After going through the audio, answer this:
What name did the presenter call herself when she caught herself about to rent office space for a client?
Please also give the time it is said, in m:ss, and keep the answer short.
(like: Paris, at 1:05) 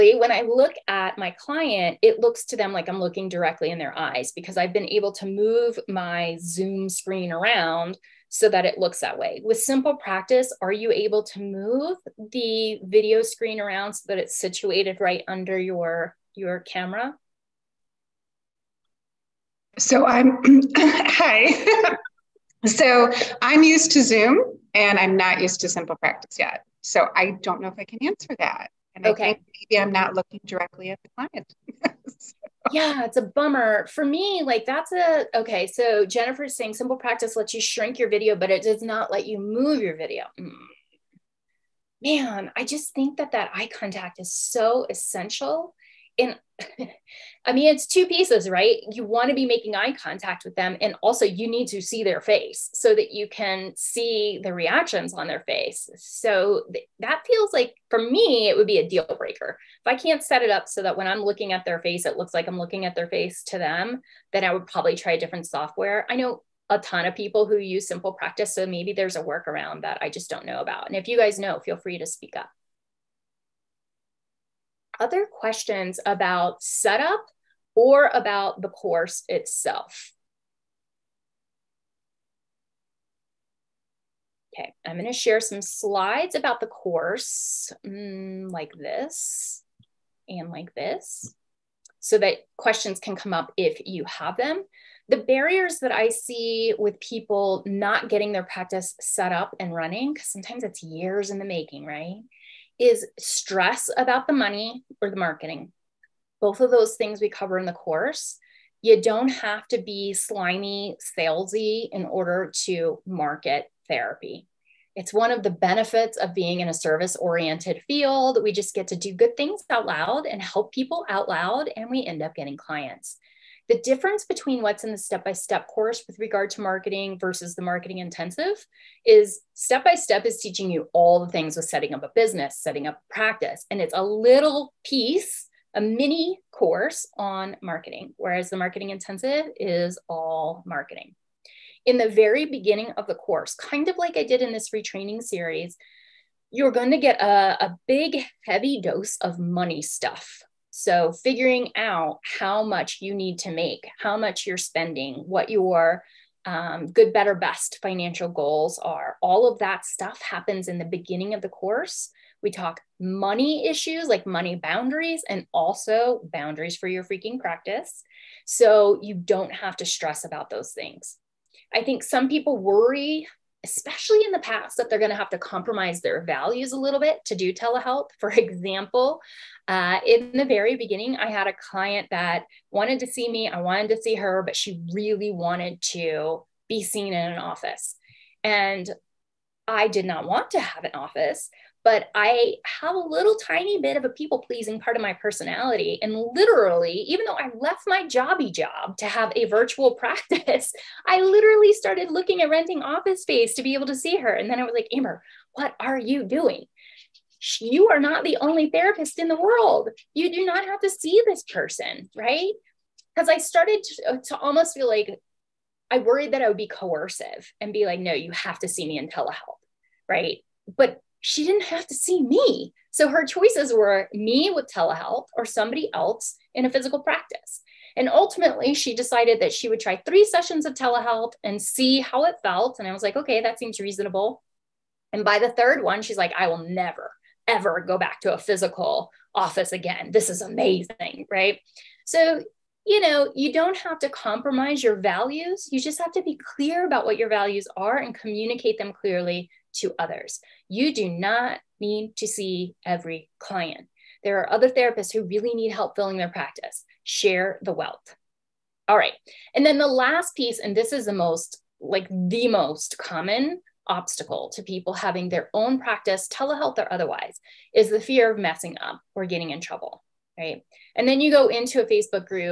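Amber, at 3:24.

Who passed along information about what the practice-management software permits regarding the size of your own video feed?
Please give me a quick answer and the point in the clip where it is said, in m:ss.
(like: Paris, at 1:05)
Jennifer, at 0:36.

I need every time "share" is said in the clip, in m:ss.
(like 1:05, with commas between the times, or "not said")
1:25, 4:17.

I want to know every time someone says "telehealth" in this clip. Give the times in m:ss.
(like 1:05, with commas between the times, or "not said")
2:57, 3:39, 3:44, 3:50, 4:26.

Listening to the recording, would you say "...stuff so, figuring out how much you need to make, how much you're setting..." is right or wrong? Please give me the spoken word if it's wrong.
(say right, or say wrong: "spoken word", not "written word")
wrong: "spending", not "setting".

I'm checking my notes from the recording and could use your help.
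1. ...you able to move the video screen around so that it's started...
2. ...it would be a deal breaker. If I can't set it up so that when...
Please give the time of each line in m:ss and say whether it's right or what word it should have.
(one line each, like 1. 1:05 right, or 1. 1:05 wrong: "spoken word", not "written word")
1. 0:10 wrong: "situated", not "started"
2. 0:58 right.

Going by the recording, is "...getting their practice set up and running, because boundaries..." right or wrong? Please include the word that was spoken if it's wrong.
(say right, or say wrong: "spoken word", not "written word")
wrong: "sometimes", not "boundaries".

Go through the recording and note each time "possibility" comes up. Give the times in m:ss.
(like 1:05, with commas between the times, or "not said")
not said.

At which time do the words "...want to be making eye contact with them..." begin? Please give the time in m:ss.
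0:49.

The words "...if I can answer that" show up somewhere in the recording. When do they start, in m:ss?
0:27.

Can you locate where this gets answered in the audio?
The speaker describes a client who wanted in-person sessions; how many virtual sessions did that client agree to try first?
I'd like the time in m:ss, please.
3:50.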